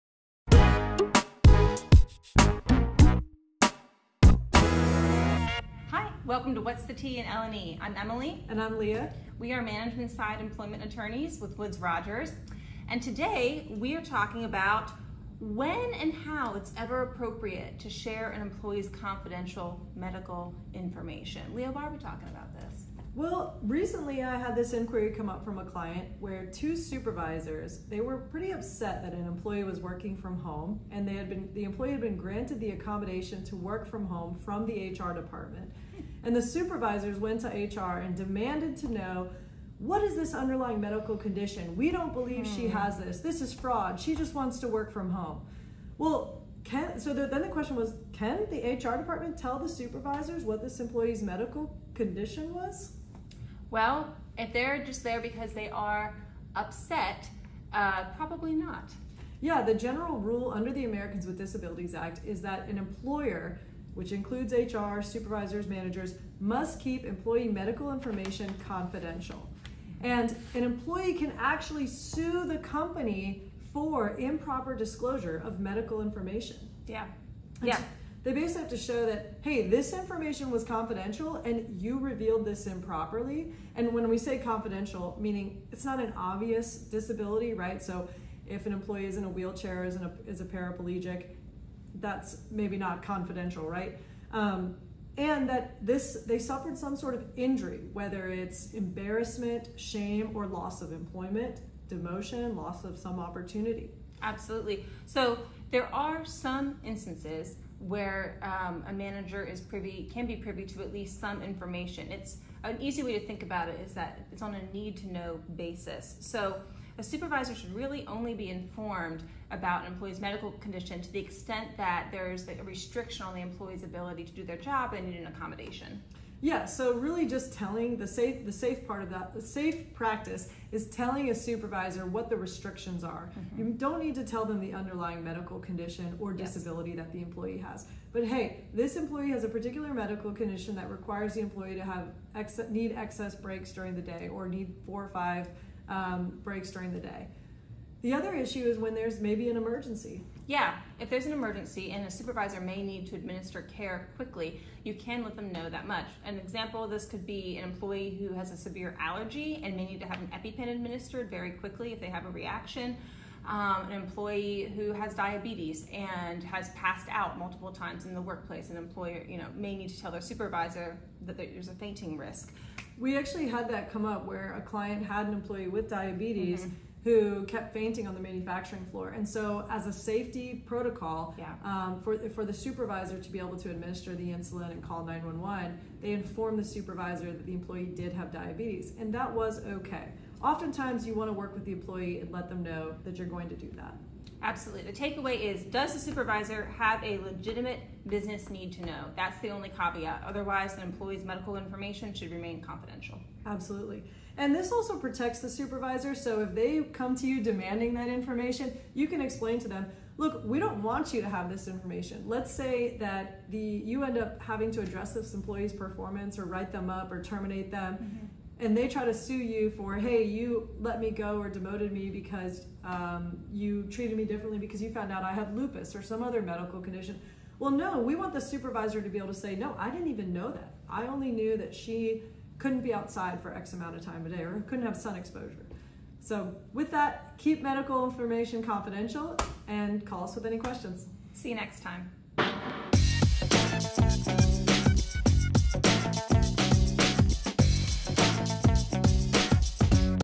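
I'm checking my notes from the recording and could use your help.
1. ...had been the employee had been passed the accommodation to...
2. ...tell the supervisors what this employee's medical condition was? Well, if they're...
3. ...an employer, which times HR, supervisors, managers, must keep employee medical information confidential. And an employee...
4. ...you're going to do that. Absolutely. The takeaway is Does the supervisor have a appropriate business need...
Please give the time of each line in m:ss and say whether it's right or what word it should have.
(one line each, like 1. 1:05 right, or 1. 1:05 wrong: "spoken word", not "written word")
1. 0:31 wrong: "granted", not "passed"
2. 0:49 right
3. 1:02 wrong: "includes", not "times"
4. 3:13 wrong: "legitimate", not "appropriate".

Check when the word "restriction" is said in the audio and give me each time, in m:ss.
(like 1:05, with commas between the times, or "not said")
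2:02, 2:12.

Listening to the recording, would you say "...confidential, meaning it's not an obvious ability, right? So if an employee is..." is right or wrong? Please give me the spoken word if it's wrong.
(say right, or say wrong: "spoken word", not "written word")
wrong: "disability", not "ability".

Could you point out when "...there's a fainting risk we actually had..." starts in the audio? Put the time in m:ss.
2:51.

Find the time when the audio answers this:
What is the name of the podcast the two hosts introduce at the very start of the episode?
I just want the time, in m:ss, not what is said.
0:06.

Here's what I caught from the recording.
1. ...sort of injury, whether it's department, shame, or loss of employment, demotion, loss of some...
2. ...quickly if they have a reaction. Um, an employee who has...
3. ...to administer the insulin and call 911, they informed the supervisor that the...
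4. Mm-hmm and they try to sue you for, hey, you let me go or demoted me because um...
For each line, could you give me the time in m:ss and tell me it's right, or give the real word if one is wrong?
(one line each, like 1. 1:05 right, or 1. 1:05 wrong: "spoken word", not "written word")
1. 1:36 wrong: "embarrassment", not "department"
2. 2:41 right
3. 3:03 right
4. 3:37 right.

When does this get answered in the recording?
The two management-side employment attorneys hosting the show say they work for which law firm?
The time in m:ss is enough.
0:11.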